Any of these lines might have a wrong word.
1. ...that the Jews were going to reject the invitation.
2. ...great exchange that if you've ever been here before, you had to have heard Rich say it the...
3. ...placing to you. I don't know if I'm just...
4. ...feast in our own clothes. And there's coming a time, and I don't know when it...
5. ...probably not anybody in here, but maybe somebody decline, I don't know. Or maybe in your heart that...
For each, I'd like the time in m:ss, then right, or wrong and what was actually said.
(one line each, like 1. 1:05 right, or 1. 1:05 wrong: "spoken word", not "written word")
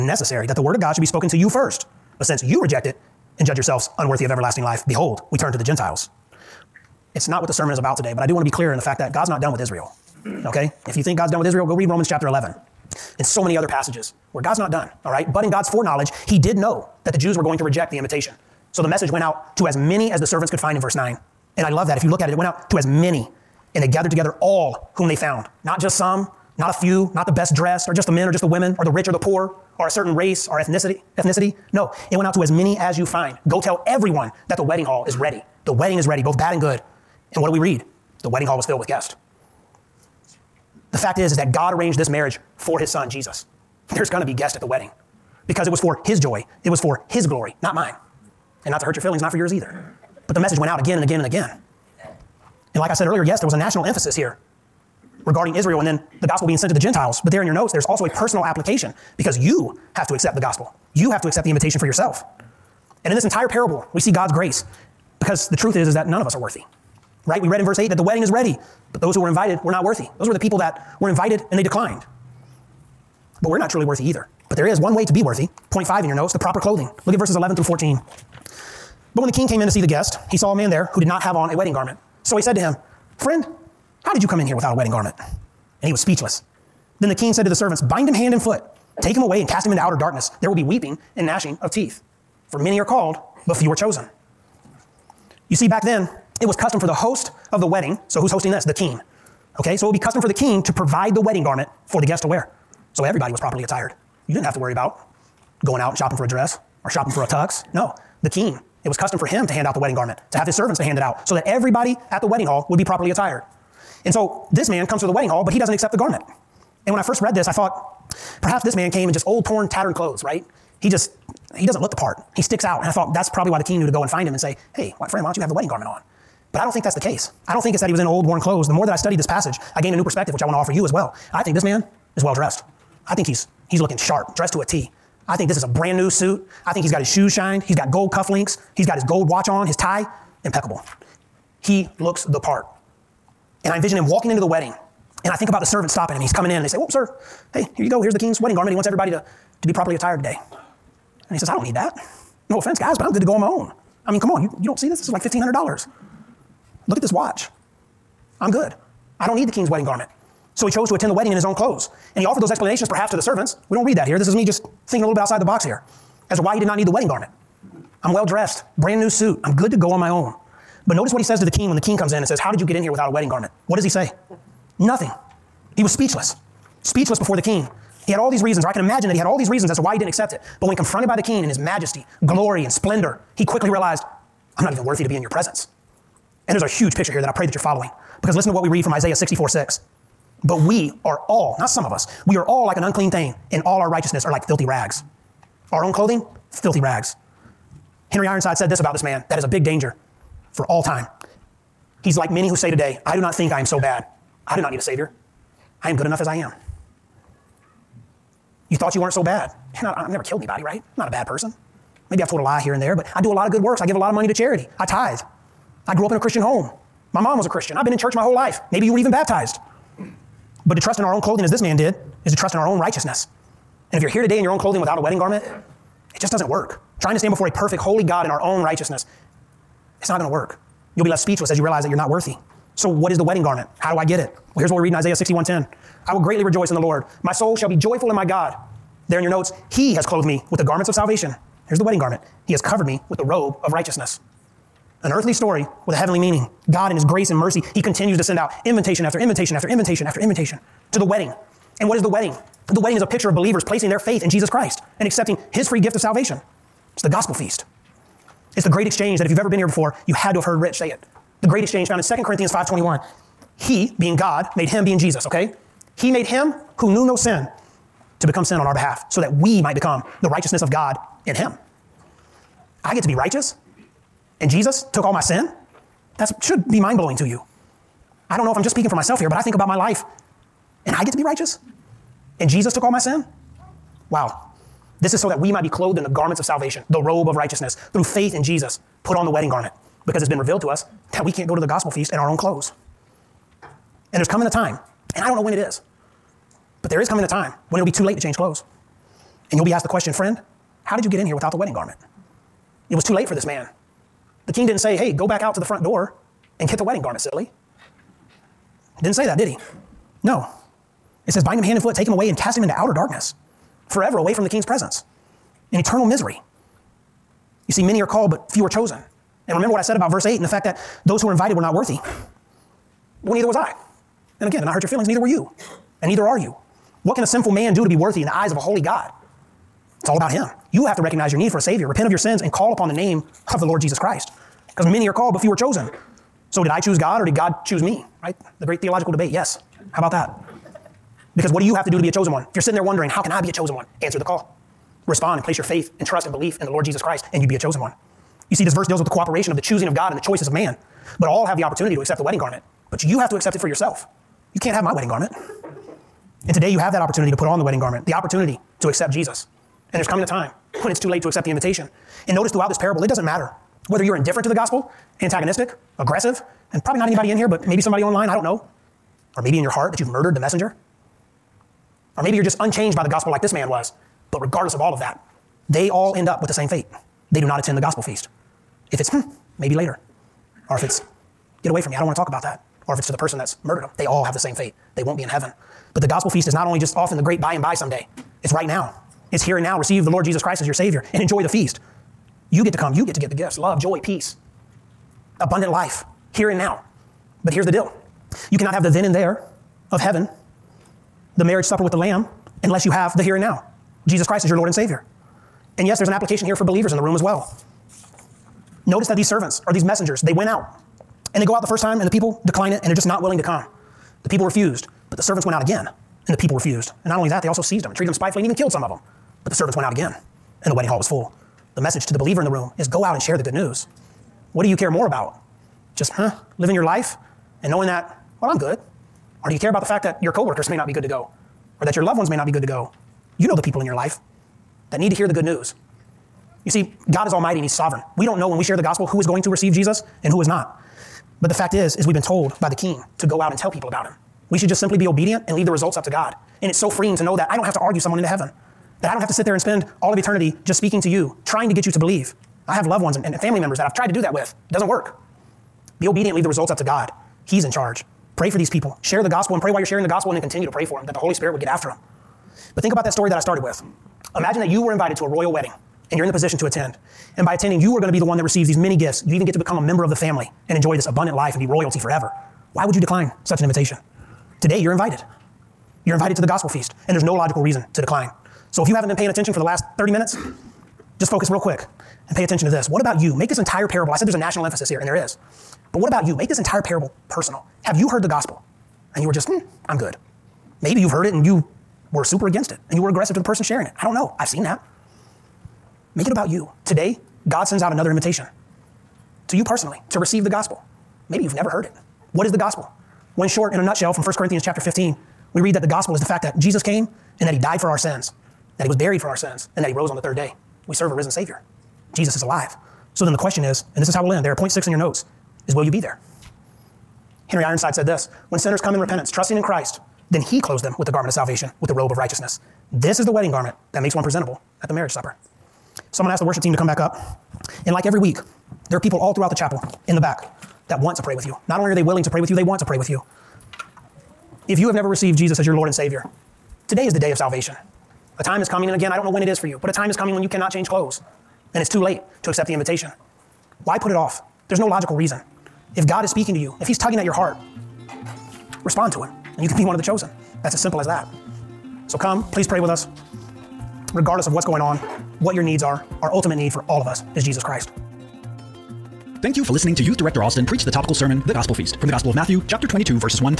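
1. 0:17 right
2. 4:18 right
3. 4:36 wrong: "blowing", not "placing"
4. 4:51 right
5. 6:06 wrong: "online", not "decline".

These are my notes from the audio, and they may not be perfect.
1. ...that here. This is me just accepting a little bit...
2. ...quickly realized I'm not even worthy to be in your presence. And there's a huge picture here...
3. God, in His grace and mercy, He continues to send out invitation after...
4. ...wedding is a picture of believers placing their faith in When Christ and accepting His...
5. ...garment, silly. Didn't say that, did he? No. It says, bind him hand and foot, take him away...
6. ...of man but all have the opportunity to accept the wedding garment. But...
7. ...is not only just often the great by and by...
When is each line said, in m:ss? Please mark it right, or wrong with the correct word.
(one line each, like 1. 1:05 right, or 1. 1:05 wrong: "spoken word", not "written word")
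1. 2:43 wrong: "thinking", not "accepting"
2. 3:03 right
3. 4:06 right
4. 4:12 wrong: "Jesus", not "When"
5. 5:07 right
6. 5:50 right
7. 6:26 right.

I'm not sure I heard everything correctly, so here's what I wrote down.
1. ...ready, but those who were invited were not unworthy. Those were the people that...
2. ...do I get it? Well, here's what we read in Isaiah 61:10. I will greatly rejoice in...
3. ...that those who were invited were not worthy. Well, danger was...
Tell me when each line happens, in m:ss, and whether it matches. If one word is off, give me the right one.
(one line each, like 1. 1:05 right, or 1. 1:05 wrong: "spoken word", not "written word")
1. 1:08 wrong: "worthy", not "unworthy"
2. 3:53 right
3. 5:20 wrong: "neither", not "danger".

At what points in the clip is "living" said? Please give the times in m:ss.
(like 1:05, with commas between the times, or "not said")
7:06.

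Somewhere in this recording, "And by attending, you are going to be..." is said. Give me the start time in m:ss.
7:47.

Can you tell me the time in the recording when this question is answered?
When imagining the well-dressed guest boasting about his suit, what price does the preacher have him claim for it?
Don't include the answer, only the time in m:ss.
2:35.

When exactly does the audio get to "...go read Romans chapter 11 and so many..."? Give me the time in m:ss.
0:11.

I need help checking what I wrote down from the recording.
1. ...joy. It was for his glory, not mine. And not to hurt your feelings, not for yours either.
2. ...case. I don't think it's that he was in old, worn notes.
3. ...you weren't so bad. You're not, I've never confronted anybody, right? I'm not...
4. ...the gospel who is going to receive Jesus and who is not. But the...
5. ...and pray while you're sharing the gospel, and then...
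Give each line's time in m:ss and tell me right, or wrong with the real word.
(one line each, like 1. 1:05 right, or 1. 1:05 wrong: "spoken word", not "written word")
1. 0:46 right
2. 2:06 wrong: "clothes", not "notes"
3. 3:28 wrong: "killed", not "confronted"
4. 7:18 right
5. 7:39 right.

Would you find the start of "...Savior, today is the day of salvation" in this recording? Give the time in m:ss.
8:55.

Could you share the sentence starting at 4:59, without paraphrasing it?
And you'll be asked the question, friend, how did you get in here without the wedding garment?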